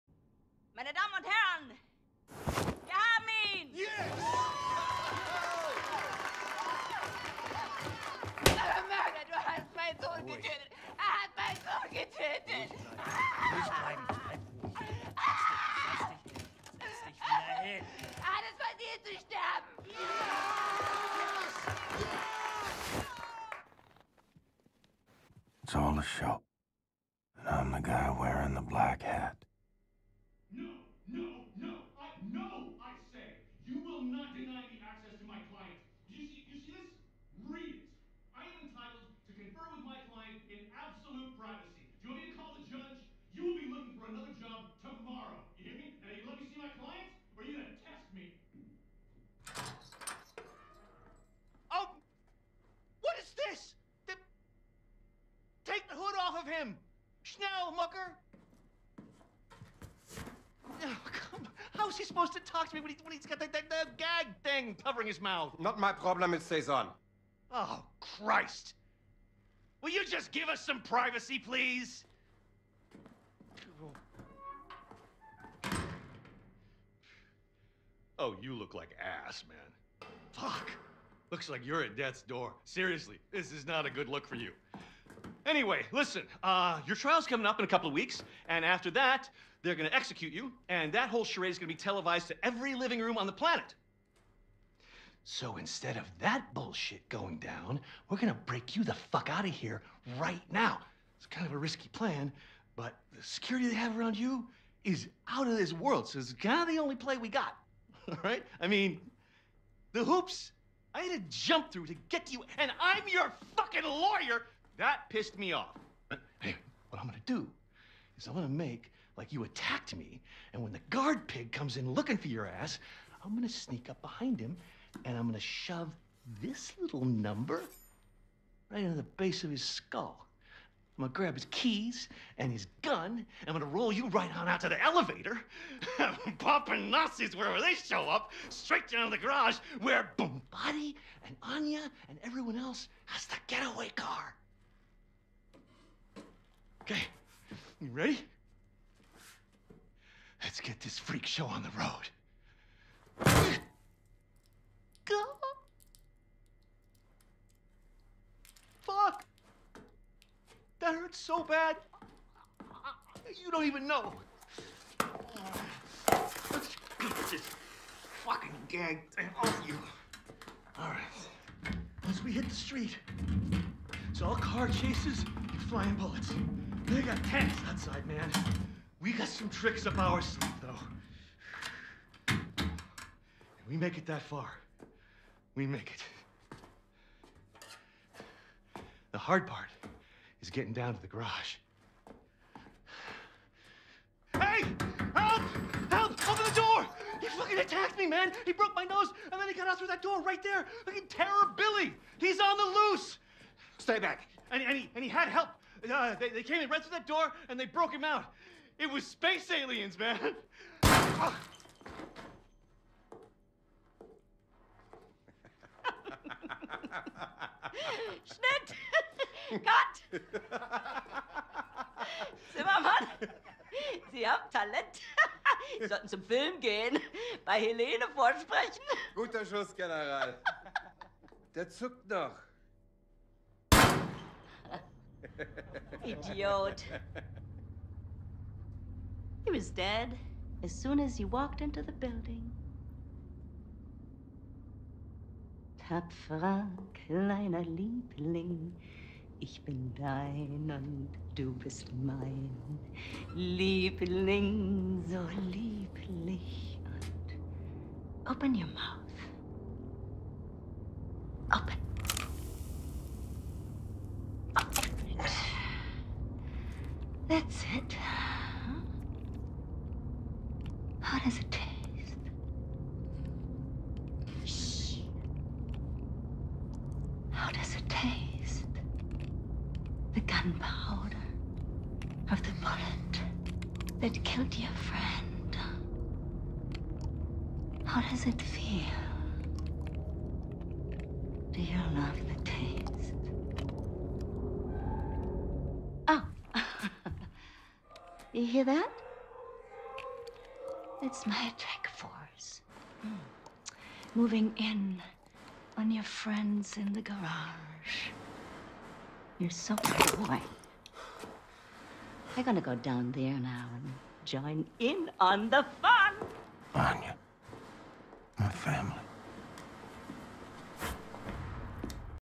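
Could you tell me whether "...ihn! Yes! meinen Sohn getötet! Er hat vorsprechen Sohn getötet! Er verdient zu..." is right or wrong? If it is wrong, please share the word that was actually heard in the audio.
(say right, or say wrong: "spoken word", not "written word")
wrong: "meinen", not "vorsprechen".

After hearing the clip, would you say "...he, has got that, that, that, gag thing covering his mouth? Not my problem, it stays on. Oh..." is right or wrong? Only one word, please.
right.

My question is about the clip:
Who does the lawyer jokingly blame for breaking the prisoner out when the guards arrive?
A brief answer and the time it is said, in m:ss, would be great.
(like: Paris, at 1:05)
space aliens, at 3:29.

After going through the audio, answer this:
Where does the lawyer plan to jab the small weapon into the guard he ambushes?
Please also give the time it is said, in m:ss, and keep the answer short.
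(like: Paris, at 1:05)
base of his skull, at 2:09.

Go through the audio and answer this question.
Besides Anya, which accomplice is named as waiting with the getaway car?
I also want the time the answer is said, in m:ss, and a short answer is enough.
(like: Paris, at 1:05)
Body, at 2:20.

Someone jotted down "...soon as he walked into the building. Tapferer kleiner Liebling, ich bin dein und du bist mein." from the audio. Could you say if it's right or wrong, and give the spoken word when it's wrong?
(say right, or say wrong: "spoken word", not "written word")
right.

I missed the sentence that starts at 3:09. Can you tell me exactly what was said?
The hard part is getting down to the garage.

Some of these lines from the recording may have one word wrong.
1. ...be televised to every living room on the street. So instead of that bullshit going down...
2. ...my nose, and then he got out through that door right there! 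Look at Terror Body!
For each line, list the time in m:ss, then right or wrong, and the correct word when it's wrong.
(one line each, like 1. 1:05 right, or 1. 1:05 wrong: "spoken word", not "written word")
1. 1:31 wrong: "planet", not "street"
2. 3:18 wrong: "Billy", not "Body".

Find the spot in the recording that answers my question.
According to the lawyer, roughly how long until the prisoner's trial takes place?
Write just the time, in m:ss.
1:27.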